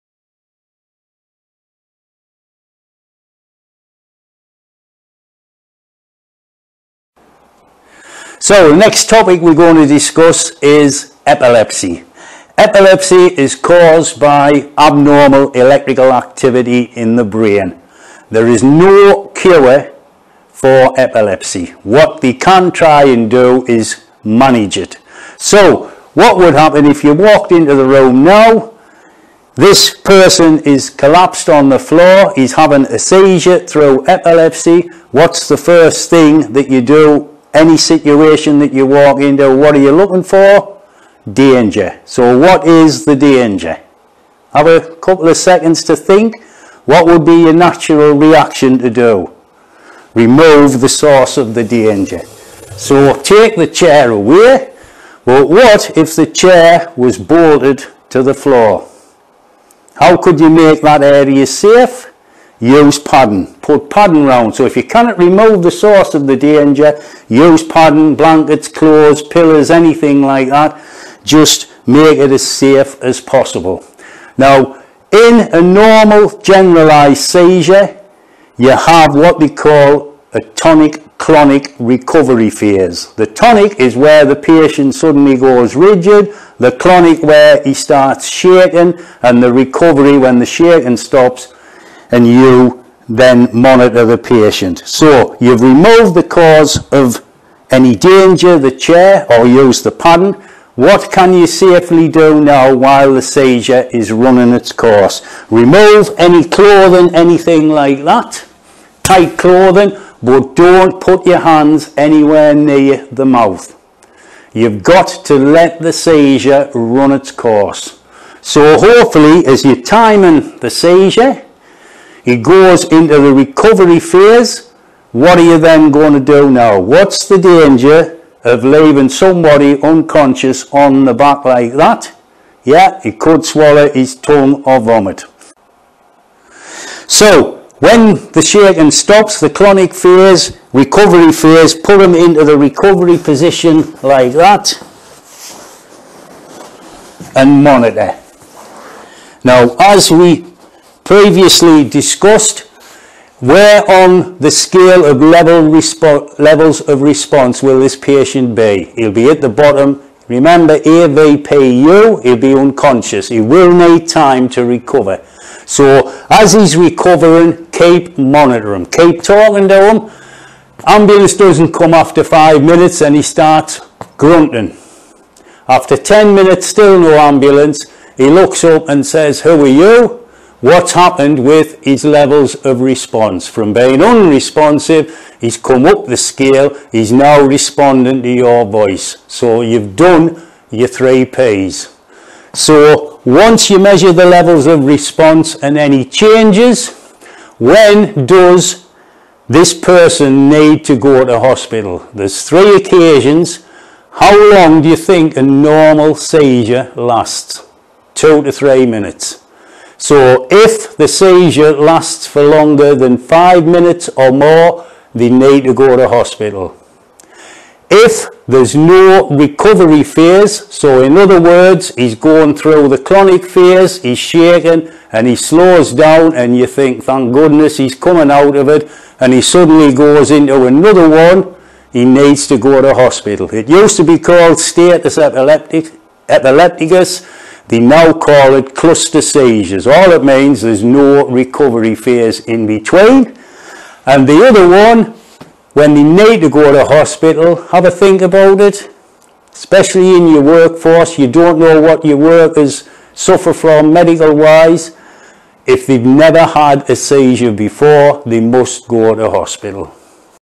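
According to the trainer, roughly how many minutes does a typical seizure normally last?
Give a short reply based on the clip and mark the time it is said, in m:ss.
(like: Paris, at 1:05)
2 to 3 minutes, at 3:28.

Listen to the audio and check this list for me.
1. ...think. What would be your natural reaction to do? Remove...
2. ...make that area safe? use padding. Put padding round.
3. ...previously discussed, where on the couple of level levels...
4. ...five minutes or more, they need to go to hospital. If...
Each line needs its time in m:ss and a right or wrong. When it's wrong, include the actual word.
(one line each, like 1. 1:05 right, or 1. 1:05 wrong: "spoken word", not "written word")
1. 0:45 right
2. 1:00 right
3. 2:31 wrong: "scale", not "couple"
4. 3:33 right.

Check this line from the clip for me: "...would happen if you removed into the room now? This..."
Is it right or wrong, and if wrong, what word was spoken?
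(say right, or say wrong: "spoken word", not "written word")
wrong: "walked", not "removed".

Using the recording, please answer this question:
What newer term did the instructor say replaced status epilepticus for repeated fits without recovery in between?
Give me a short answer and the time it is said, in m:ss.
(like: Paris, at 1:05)
Cluster seizures, at 3:58.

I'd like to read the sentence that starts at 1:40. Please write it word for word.
What can you safely do now while the seizure is running its course?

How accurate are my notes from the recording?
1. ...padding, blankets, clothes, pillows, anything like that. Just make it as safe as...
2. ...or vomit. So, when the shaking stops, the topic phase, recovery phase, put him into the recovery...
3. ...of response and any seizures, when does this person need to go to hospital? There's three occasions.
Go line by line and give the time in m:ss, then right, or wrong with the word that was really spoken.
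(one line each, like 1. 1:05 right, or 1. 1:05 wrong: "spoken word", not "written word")
1. 1:07 right
2. 2:14 wrong: "clonic", not "topic"
3. 3:14 wrong: "changes", not "seizures".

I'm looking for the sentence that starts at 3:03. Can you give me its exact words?
From being unresponsive, he's come up the scale, he's now responding to your voice.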